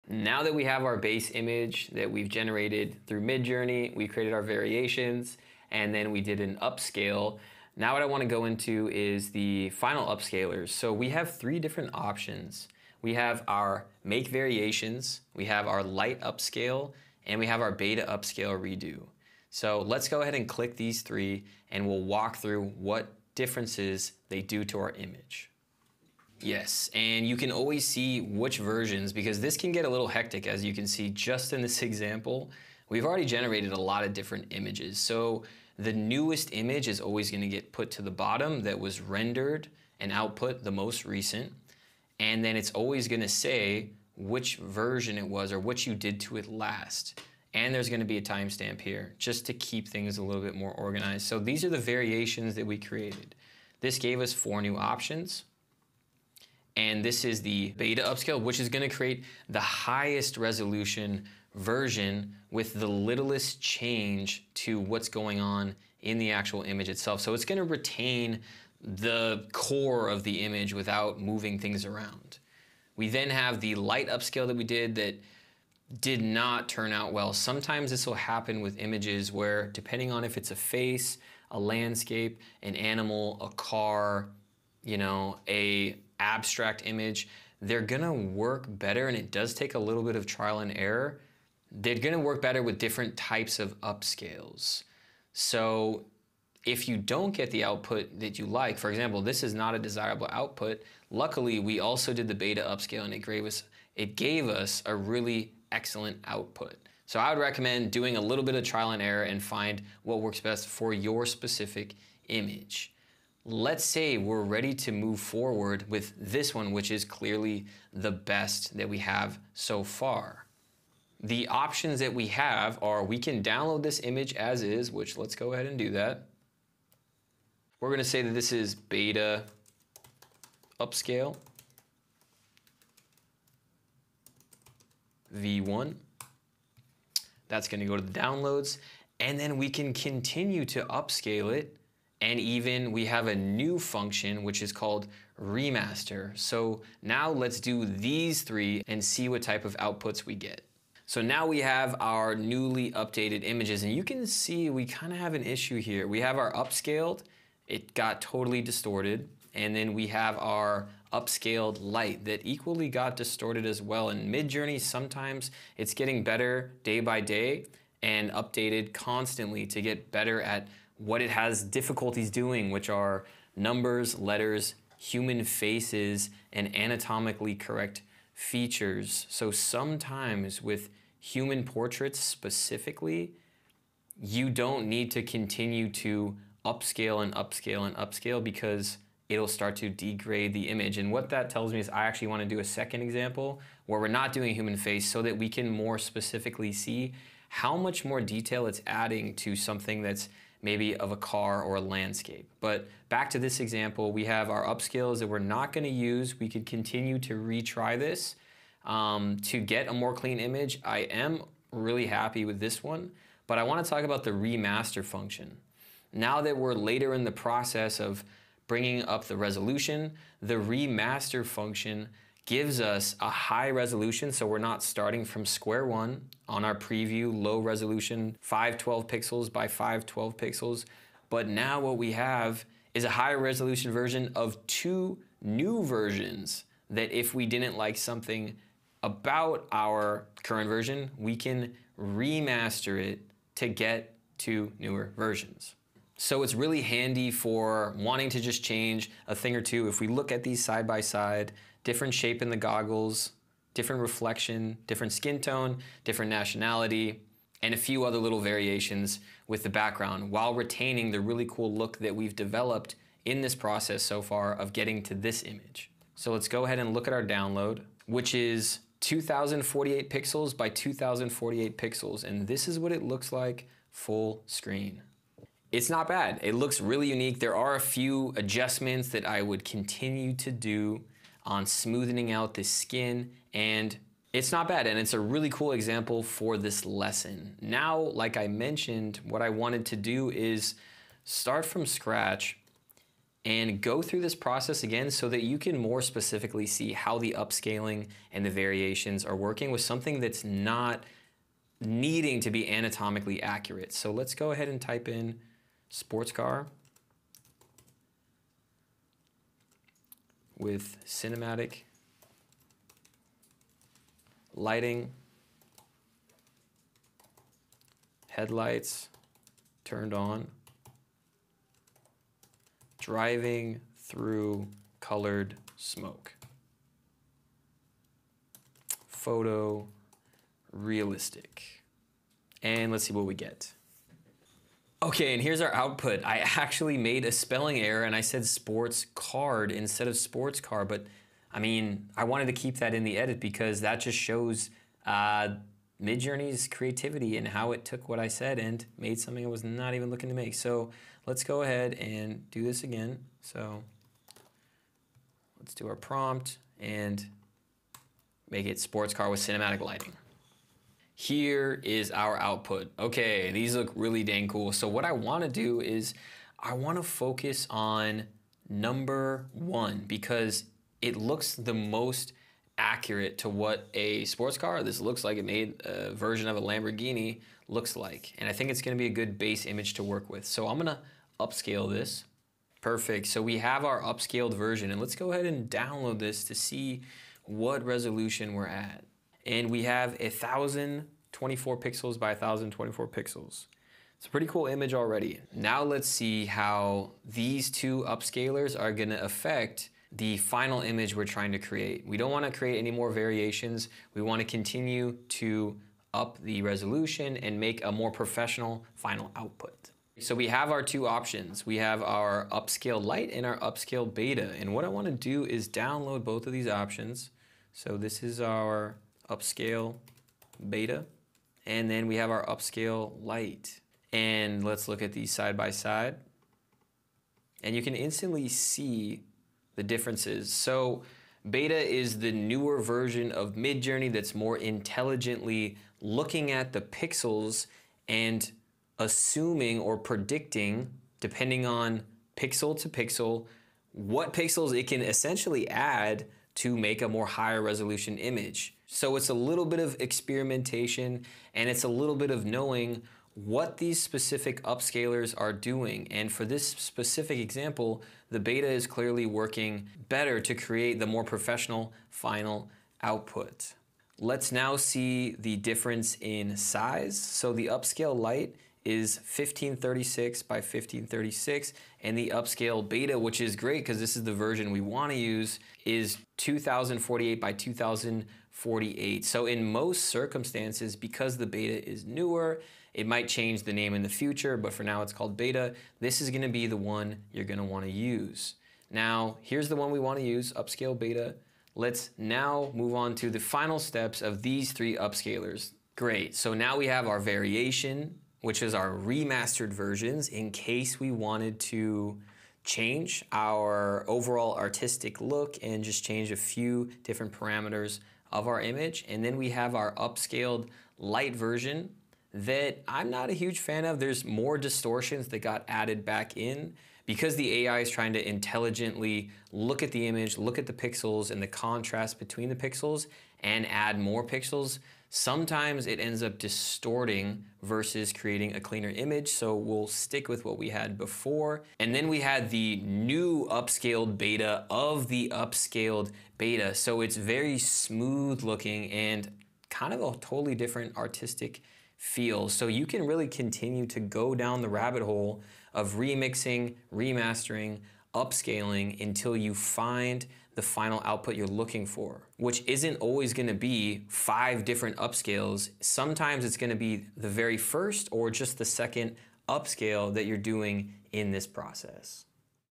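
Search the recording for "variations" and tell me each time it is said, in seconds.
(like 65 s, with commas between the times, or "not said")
4 s, 14 s, 51 s, 258 s, 298 s, 403 s, 497 s.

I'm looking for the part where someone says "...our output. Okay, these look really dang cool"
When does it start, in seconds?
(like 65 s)
362 s.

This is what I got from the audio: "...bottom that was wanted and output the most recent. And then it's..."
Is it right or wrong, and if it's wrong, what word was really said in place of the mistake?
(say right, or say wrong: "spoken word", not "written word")
wrong: "rendered", not "wanted".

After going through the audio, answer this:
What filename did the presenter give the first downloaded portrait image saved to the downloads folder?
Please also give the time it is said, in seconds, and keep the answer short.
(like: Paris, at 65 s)
beta upscale v1, at 128 s.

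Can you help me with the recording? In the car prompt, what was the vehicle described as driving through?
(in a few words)
colored smoke.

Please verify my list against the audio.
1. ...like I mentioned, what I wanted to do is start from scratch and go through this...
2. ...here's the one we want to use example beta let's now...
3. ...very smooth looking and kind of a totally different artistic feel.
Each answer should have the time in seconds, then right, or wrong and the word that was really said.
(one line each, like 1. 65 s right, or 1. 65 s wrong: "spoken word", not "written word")
1. 287 s right
2. 489 s wrong: "upscale", not "example"
3. 537 s right.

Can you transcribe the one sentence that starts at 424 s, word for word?
And let's look at these side by side.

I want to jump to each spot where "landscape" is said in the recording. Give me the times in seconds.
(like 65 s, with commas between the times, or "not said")
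81 s, 201 s.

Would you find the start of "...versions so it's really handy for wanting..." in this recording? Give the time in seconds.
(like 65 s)
245 s.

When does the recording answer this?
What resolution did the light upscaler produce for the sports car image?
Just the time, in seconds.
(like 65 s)
469 s.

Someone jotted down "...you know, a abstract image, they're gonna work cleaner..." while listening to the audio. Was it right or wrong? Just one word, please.
wrong.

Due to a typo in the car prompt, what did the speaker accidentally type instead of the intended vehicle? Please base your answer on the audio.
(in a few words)
sports card.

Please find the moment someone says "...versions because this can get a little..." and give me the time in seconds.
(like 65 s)
28 s.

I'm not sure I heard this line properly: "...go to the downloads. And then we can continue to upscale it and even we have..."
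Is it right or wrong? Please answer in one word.
right.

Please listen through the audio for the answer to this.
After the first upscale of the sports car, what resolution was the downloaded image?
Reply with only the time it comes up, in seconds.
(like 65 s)
390 s.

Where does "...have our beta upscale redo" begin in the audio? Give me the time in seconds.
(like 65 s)
17 s.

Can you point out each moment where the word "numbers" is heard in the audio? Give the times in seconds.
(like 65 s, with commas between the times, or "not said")
173 s, 368 s.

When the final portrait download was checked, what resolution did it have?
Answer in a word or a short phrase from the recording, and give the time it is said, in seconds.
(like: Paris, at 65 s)
2048 by 2048 pixels, at 269 s.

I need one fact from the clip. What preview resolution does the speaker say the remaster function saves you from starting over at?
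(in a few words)
512 by 512 pixels.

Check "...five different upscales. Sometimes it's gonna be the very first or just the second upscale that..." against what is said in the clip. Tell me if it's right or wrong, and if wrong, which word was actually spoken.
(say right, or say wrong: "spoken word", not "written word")
right.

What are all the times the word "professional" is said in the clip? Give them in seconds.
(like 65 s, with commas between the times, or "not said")
408 s, 461 s.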